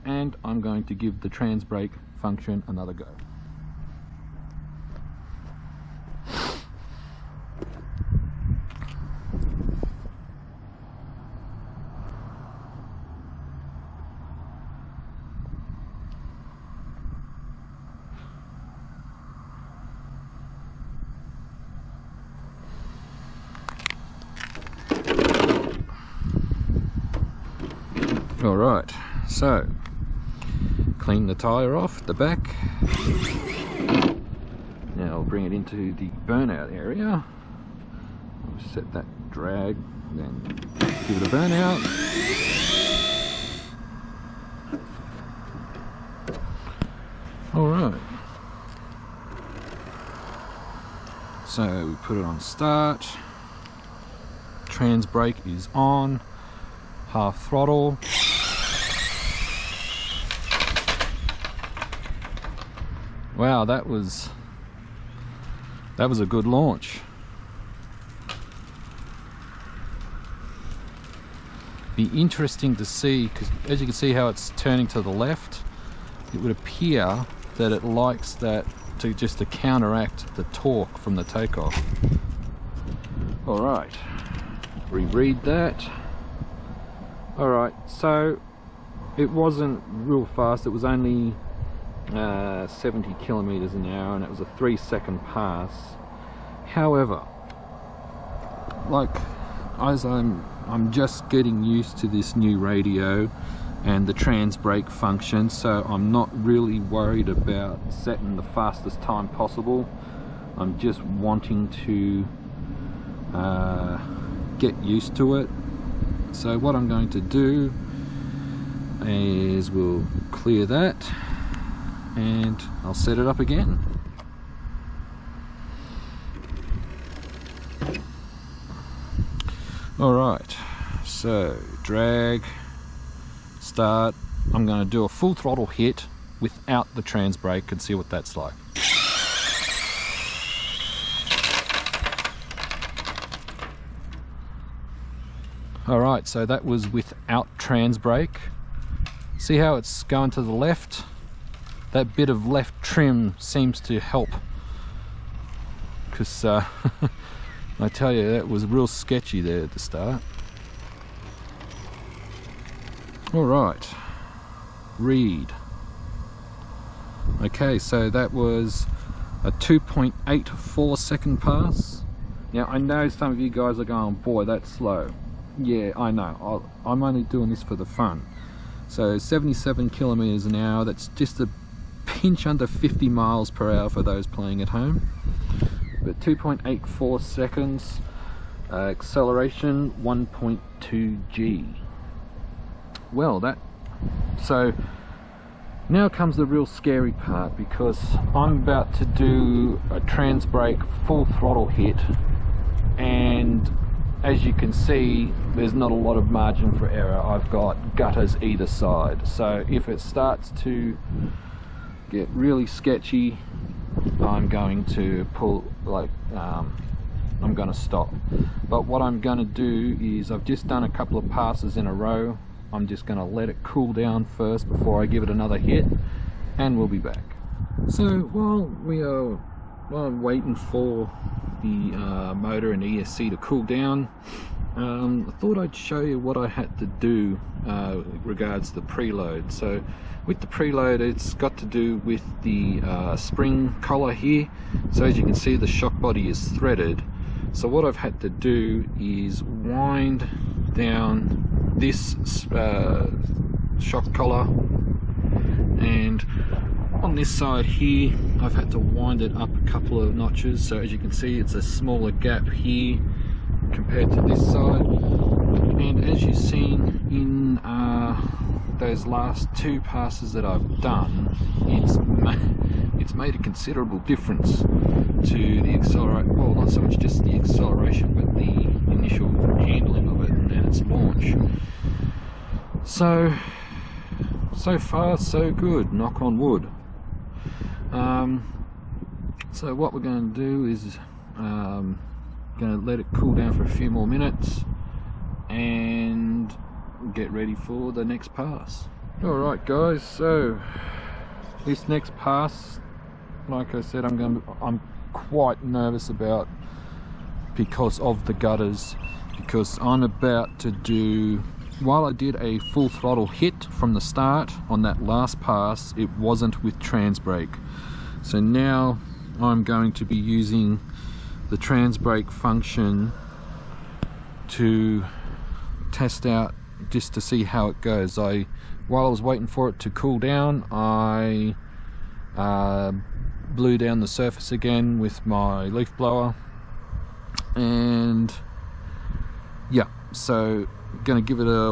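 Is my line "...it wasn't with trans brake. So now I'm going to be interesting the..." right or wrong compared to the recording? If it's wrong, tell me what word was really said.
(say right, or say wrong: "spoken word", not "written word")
wrong: "using", not "interesting".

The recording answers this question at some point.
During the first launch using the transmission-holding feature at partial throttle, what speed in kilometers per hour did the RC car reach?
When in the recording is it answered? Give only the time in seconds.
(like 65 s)
92 s.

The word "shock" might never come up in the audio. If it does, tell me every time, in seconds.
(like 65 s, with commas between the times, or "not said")
245 s, 253 s.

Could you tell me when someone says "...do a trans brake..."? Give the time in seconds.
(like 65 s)
199 s.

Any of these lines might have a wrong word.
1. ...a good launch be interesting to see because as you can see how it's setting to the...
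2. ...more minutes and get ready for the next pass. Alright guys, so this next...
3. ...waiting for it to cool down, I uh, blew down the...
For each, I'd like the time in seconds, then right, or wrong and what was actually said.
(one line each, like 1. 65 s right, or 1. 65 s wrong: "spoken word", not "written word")
1. 66 s wrong: "turning", not "setting"
2. 293 s right
3. 329 s right.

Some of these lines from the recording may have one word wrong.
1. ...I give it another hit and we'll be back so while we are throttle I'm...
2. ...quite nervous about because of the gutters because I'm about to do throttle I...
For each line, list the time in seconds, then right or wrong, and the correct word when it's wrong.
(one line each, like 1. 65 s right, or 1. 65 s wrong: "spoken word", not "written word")
1. 225 s wrong: "while", not "throttle"
2. 305 s wrong: "while", not "throttle".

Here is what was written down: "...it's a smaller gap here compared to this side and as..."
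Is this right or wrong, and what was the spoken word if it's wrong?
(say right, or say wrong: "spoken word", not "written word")
right.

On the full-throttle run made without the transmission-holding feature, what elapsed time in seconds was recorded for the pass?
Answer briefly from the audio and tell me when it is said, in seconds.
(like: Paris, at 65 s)
2.84, at 169 s.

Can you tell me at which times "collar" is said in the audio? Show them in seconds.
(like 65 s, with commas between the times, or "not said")
243 s, 254 s.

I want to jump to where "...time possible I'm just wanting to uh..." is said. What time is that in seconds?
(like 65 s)
109 s.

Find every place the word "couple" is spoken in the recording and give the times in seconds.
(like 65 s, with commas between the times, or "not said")
220 s, 259 s.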